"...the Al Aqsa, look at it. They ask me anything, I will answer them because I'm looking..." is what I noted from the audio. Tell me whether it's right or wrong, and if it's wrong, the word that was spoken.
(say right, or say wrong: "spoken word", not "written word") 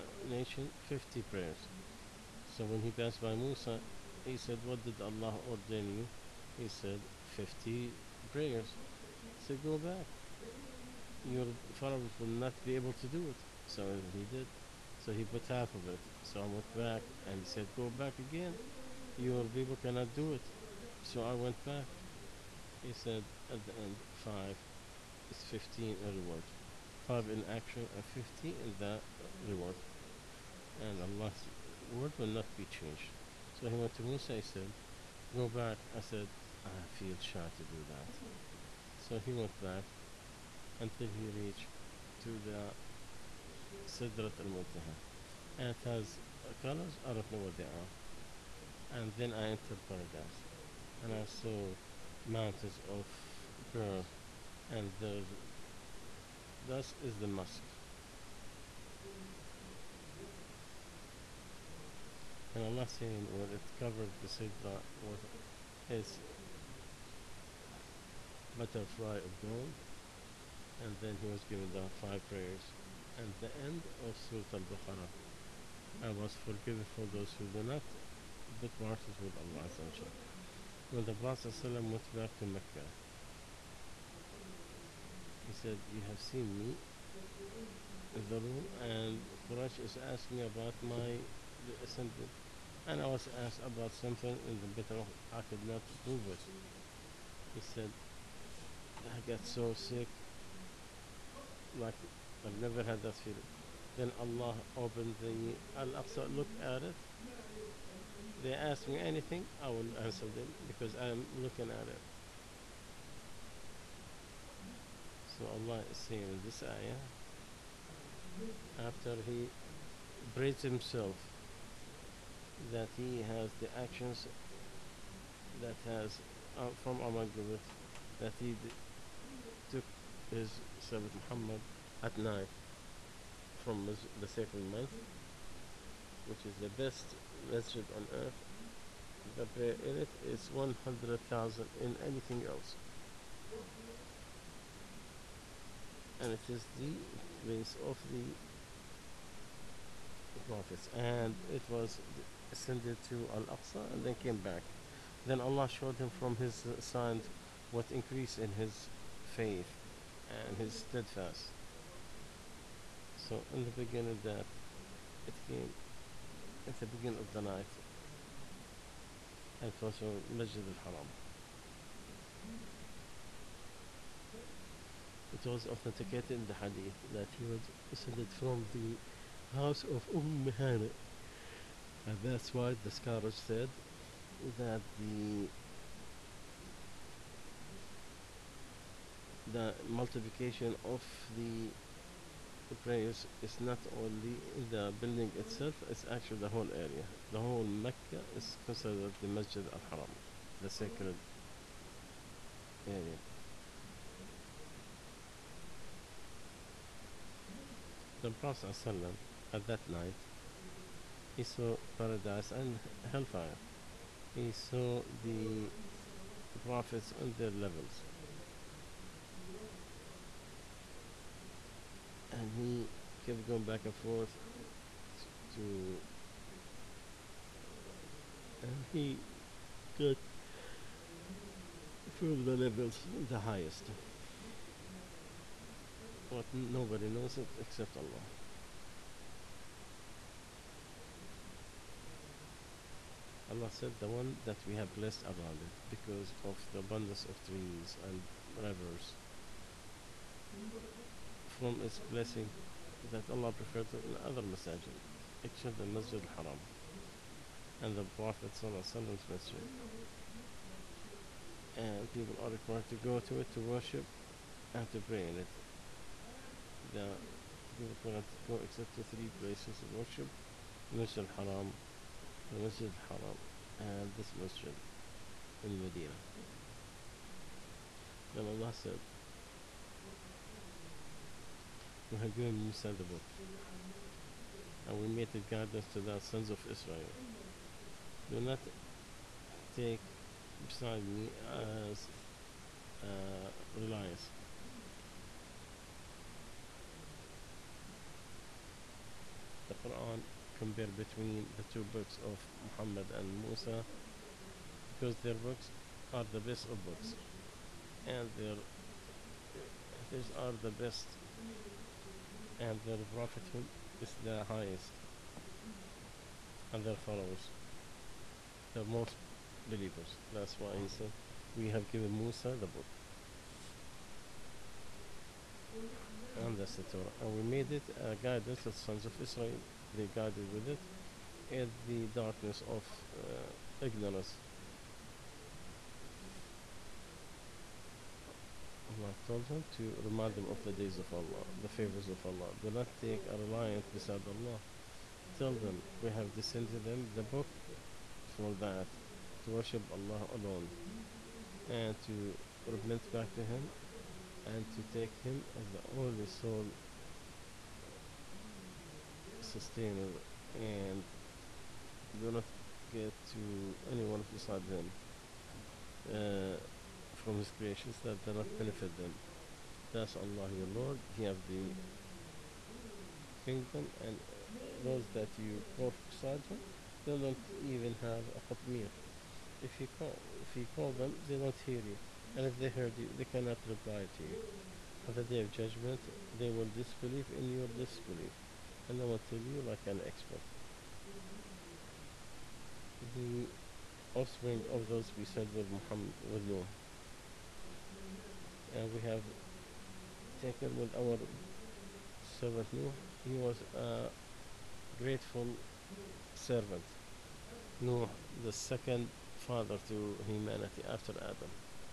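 right.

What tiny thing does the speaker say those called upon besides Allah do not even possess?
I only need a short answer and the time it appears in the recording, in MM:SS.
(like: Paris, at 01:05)
qatmir, at 06:18.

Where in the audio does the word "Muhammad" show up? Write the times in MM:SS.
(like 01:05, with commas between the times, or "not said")
02:11, 05:02, 05:38, 06:35.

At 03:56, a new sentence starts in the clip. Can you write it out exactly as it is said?
But nobody knows it except Allah.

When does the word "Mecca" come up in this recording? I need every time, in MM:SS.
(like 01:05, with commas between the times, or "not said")
01:22, 03:17.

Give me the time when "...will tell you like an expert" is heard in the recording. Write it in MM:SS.
06:29.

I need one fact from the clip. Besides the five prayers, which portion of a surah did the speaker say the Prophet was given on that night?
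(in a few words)
end of Surah Al Baqarah.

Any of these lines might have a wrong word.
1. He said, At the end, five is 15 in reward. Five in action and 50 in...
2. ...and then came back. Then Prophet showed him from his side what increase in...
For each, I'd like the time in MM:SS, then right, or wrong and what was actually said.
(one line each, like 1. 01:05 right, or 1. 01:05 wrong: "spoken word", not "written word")
1. 00:22 right
2. 02:33 wrong: "Allah", not "Prophet".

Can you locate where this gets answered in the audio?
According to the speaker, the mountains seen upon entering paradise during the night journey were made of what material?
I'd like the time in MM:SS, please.
00:53.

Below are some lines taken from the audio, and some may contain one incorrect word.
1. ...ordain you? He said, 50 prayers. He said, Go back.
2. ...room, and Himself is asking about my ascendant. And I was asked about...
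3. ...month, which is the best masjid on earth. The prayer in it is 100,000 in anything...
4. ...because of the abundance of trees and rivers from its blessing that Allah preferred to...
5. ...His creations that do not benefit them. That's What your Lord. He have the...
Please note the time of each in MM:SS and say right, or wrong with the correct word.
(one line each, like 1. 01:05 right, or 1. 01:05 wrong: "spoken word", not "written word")
1. 00:05 right
2. 01:28 wrong: "Quraysh", not "Himself"
3. 02:14 right
4. 04:05 right
5. 06:07 wrong: "Allah", not "What".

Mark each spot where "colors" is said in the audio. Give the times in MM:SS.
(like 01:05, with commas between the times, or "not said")
00:46.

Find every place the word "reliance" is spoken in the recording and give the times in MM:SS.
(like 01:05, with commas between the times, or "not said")
04:53, 05:43.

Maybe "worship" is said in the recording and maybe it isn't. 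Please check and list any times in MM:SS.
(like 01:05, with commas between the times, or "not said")
04:23, 04:29, 05:49.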